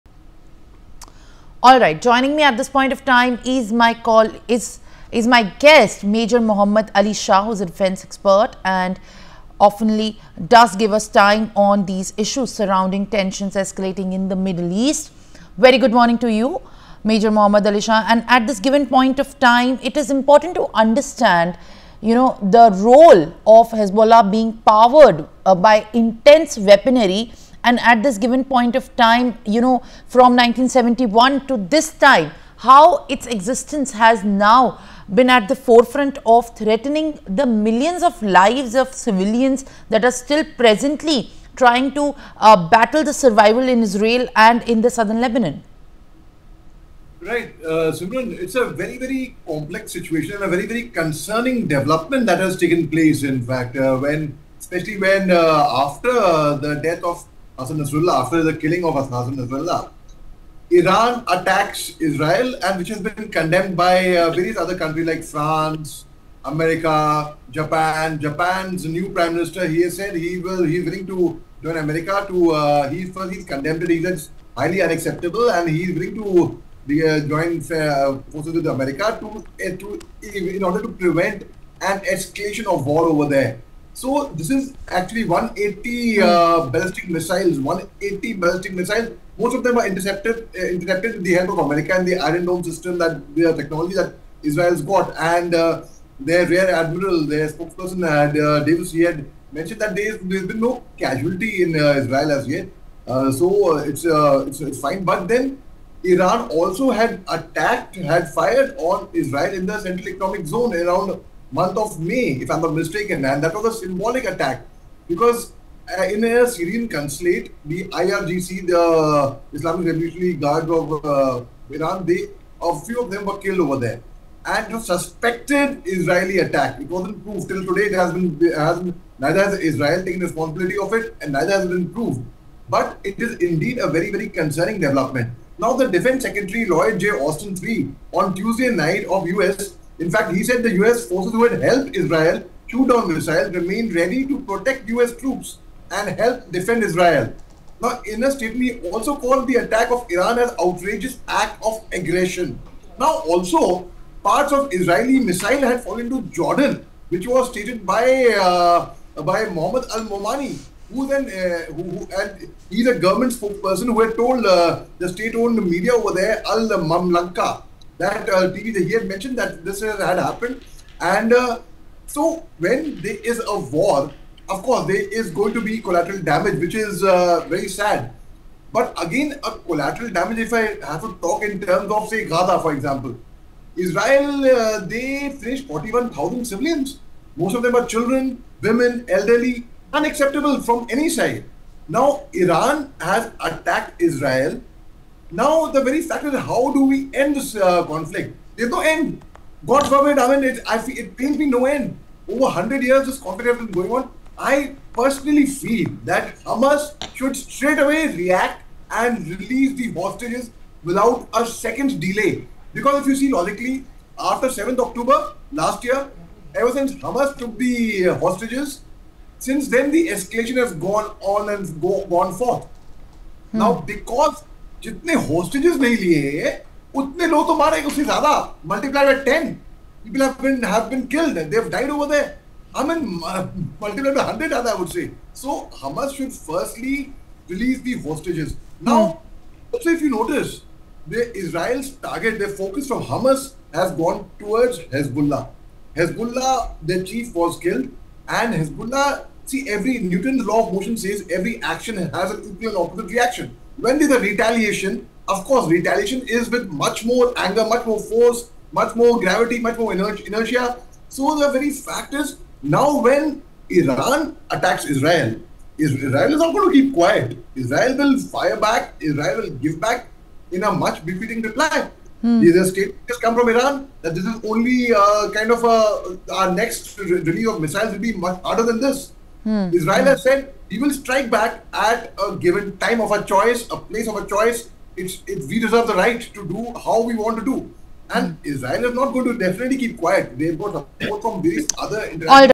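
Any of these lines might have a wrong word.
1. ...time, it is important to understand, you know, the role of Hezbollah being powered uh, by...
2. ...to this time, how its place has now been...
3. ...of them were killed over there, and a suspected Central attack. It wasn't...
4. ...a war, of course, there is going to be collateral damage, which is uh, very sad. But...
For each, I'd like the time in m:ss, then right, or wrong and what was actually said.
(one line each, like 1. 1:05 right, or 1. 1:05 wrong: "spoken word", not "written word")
1. 0:19 right
2. 0:31 wrong: "existence", not "place"
3. 2:03 wrong: "Israeli", not "Central"
4. 2:53 right.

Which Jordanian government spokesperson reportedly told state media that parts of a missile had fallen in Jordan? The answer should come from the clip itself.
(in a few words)
Mohammed Al Momani.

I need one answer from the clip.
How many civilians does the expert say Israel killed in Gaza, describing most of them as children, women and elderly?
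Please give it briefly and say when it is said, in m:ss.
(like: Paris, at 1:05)
41,000, at 3:05.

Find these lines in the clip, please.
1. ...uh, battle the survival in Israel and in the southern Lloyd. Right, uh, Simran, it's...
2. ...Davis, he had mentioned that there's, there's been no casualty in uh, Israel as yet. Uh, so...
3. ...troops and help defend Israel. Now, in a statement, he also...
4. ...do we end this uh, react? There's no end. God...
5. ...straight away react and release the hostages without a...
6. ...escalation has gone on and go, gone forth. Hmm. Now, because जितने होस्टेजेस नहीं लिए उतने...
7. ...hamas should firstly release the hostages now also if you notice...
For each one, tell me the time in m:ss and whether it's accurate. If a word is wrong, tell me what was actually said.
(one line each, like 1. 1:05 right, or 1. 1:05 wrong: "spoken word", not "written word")
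1. 0:42 wrong: "Lebanon", not "Lloyd"
2. 1:38 right
3. 2:25 right
4. 3:16 wrong: "conflict", not "react"
5. 3:27 right
6. 3:40 right
7. 3:55 right.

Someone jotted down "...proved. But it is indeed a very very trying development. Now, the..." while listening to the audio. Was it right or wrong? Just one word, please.
wrong.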